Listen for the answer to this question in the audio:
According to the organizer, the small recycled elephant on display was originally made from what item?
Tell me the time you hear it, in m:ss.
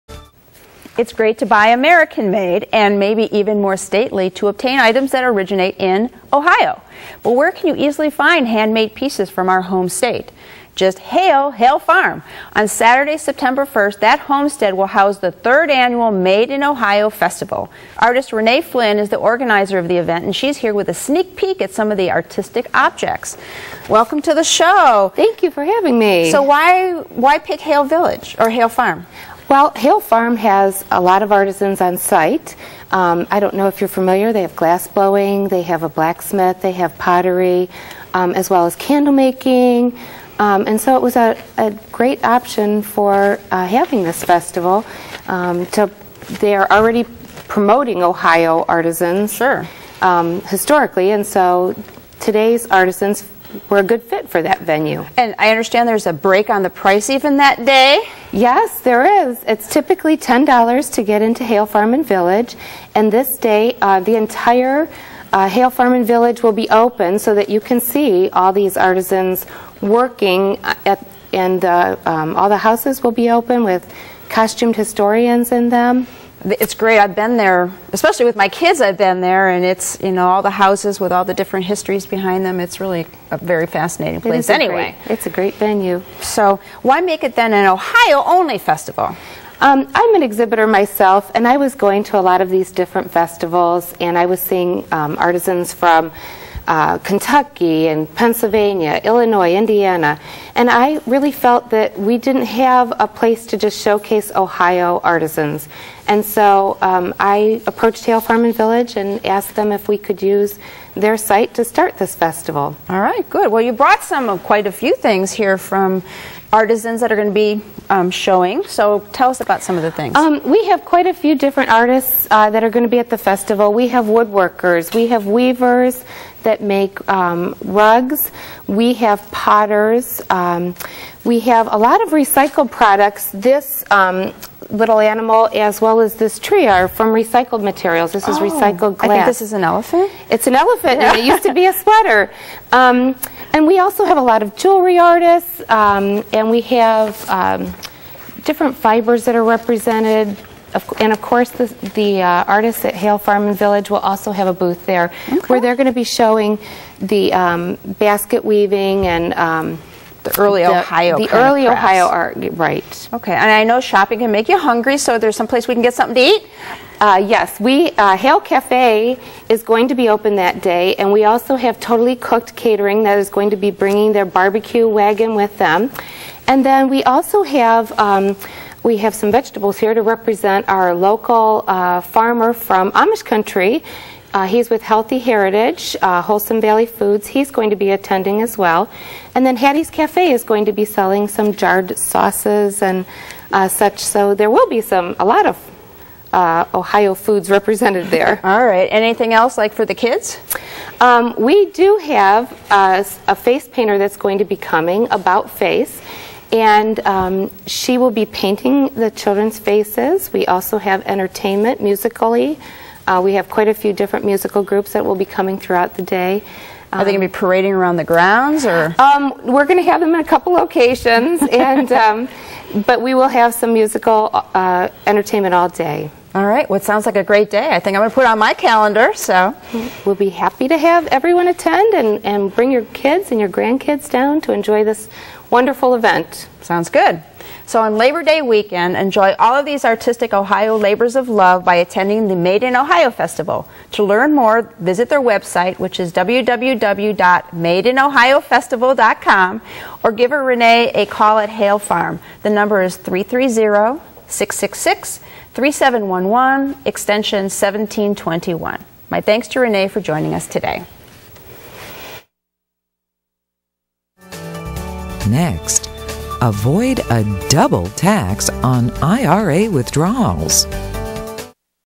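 2:21.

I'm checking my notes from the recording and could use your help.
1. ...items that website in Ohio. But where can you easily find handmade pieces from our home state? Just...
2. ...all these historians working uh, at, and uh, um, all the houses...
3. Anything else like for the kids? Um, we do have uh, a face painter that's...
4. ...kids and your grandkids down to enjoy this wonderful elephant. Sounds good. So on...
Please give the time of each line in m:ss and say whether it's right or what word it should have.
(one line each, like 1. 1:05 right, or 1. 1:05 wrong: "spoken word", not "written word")
1. 0:04 wrong: "originate", not "website"
2. 1:08 wrong: "artisans", not "historians"
3. 3:18 right
4. 3:52 wrong: "event", not "elephant".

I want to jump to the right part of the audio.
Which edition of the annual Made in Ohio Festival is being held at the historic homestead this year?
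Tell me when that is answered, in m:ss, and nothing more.
0:15.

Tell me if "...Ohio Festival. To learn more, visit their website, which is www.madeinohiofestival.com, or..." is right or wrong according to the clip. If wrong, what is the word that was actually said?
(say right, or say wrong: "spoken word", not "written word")
right.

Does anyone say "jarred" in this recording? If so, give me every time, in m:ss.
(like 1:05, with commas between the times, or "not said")
3:11.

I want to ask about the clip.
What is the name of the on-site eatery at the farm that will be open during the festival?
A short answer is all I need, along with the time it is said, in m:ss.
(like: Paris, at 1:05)
Hale Cafe, at 2:48.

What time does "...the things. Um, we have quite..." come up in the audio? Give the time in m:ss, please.
1:59.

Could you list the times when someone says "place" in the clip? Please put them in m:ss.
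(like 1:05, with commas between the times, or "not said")
1:24, 1:43, 2:45.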